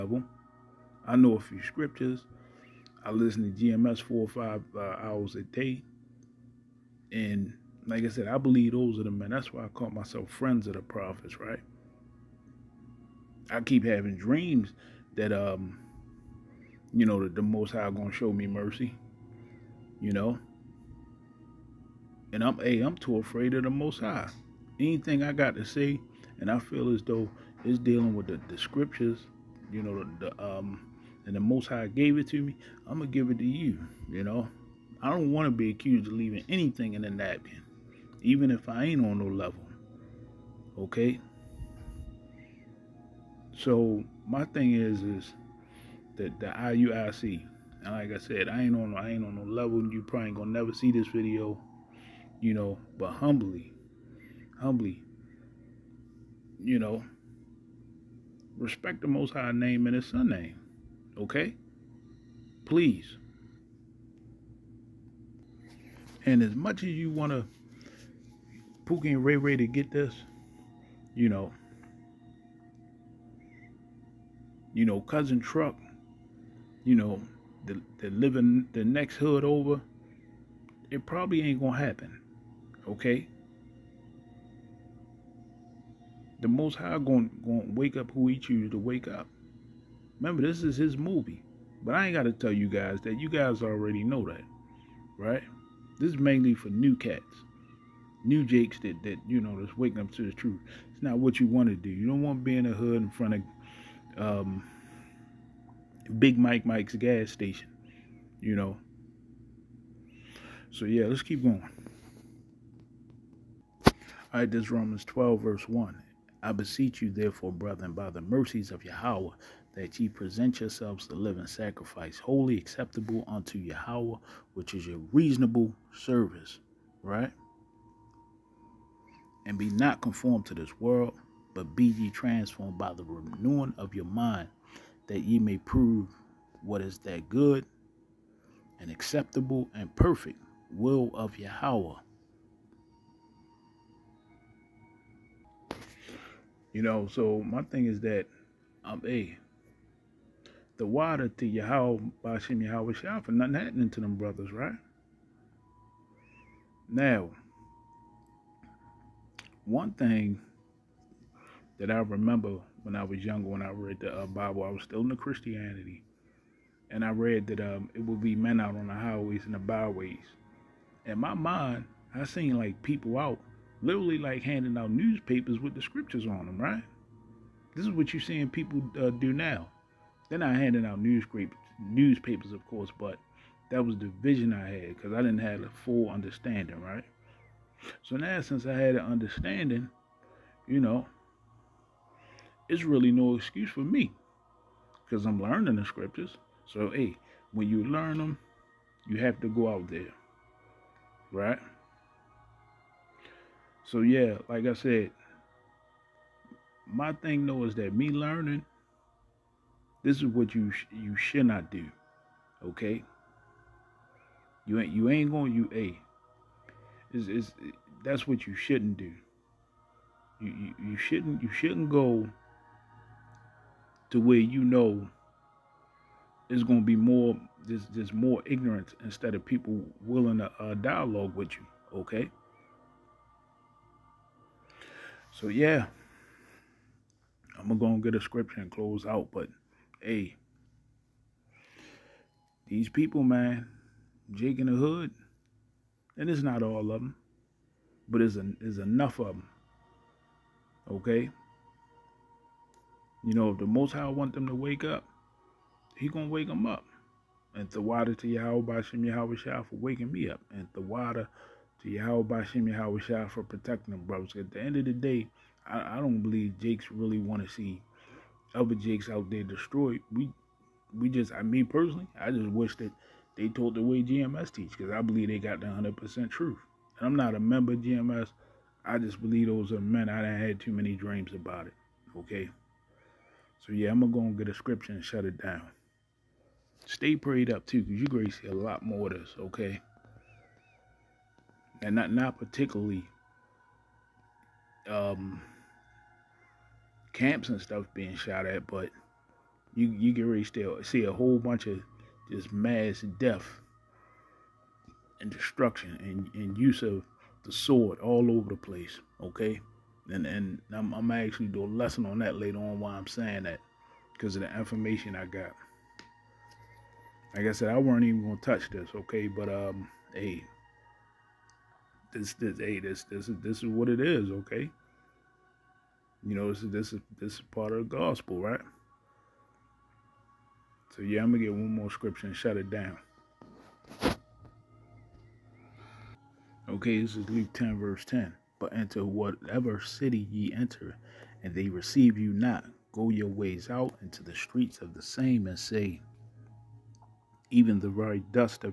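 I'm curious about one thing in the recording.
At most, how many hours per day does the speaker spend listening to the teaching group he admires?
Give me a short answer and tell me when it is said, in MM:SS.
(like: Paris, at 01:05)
5, at 00:04.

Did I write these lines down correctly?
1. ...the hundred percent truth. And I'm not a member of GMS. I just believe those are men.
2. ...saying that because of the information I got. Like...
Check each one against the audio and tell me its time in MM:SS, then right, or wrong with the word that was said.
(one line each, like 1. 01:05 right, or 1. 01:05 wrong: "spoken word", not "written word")
1. 04:35 right
2. 05:13 right.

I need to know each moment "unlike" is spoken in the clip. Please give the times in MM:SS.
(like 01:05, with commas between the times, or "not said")
not said.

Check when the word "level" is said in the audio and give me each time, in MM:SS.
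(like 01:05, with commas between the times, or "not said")
00:39, 00:49.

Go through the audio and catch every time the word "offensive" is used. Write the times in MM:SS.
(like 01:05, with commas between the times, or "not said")
not said.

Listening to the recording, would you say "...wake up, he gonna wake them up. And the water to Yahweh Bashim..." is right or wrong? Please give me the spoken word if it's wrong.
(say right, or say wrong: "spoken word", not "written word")
right.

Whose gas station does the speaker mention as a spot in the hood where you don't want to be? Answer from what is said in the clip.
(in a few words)
Big Mike Mike.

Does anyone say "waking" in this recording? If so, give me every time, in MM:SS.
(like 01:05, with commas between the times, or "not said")
01:39, 04:19.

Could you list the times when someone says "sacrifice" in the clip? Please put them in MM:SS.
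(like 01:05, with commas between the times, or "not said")
02:01.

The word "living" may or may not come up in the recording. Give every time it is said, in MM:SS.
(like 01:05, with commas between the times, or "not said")
01:18, 02:01.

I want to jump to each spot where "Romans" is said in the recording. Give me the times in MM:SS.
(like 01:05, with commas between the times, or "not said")
01:54.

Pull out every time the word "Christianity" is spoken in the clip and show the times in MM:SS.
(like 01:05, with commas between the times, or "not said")
02:45.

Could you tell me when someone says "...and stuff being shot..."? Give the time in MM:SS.
04:57.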